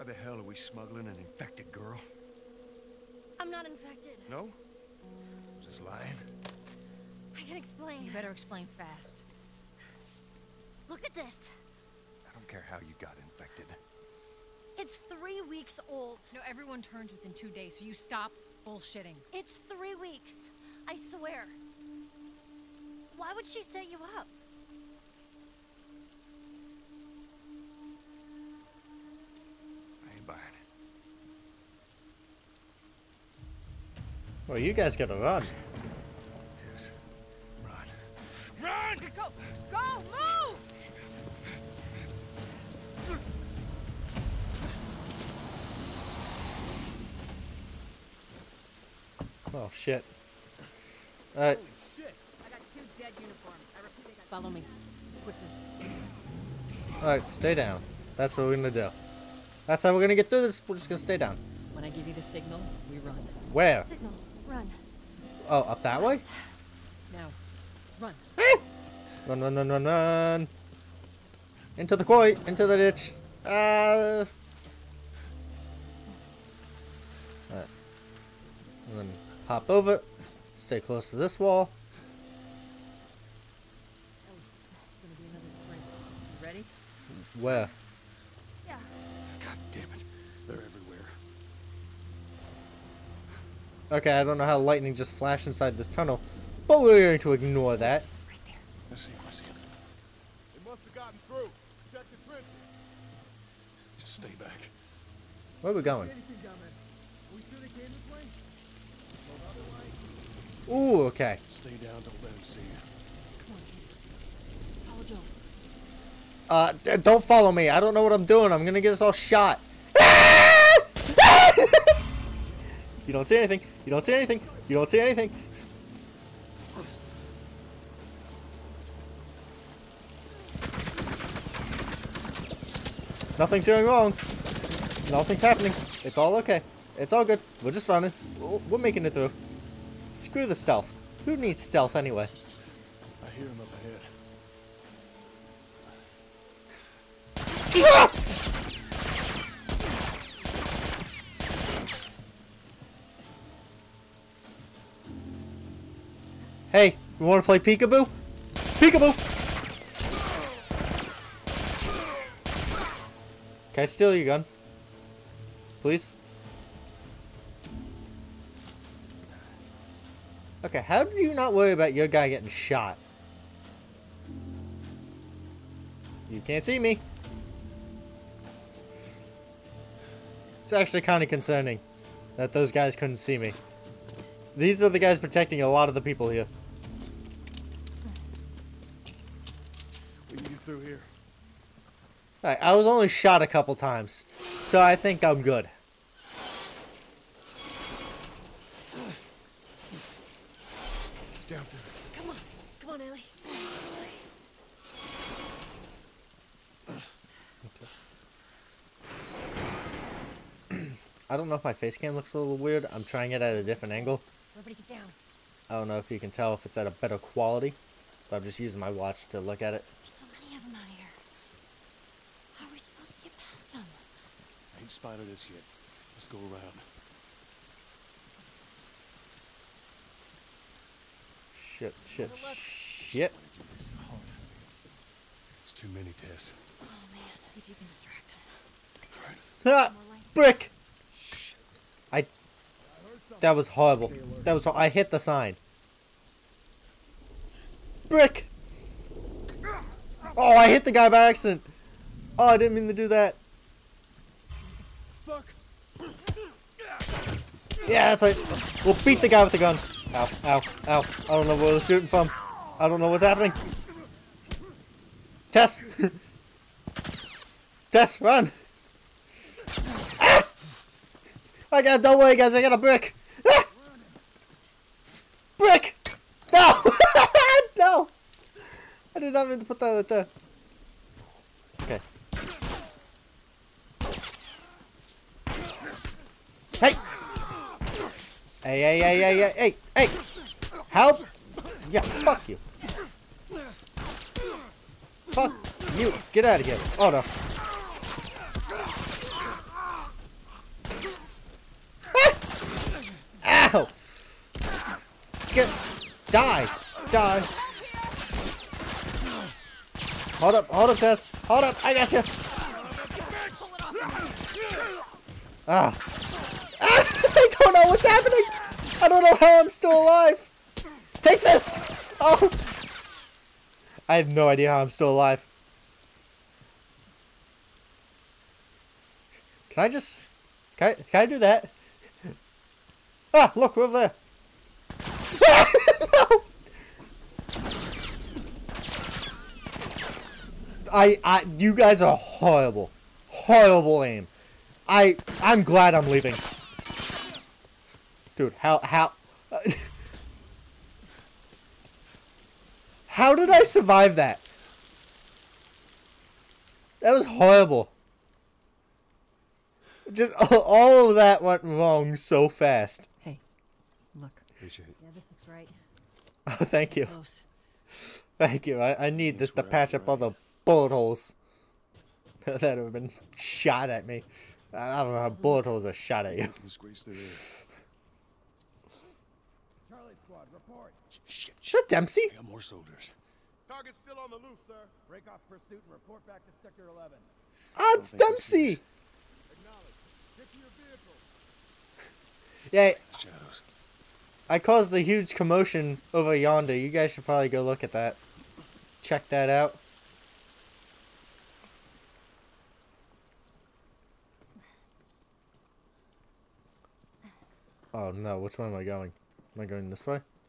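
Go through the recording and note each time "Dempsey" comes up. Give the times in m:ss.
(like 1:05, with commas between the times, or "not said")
6:21, 6:28.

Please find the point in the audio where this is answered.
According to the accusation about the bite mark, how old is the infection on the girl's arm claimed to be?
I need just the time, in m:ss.
0:15.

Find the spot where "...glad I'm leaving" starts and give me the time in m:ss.
5:45.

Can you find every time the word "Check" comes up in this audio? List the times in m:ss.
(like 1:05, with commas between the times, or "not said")
1:41, 6:39.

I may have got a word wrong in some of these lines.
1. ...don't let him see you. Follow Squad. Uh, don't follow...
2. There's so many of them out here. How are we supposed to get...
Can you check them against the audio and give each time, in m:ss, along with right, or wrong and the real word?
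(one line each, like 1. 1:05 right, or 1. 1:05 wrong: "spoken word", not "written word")
1. 1:52 wrong: "Joe", not "Squad"
2. 3:39 right.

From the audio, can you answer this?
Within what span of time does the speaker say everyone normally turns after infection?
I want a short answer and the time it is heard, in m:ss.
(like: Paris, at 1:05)
2 days, at 0:17.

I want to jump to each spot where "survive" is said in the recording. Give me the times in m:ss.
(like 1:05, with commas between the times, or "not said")
5:53.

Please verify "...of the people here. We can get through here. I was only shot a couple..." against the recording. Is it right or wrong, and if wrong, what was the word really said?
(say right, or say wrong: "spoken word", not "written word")
right.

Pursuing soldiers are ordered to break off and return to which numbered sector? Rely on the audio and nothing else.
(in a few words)
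Sector 11.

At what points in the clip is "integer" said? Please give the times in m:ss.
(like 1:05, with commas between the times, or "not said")
not said.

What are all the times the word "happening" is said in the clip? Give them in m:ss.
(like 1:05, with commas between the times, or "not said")
2:15, 4:23, 5:18.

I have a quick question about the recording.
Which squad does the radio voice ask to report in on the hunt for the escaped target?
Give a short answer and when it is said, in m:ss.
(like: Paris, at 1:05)
Charlie Squad, at 6:16.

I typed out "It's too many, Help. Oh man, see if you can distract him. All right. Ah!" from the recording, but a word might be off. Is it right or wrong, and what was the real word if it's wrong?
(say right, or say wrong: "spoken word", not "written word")
wrong: "Tess", not "Help".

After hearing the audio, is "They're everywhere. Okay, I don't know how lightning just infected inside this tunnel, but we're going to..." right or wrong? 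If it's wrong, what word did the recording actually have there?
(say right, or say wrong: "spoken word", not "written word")
wrong: "flashed", not "infected".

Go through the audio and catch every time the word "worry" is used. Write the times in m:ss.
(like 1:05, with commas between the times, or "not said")
2:51, 4:32.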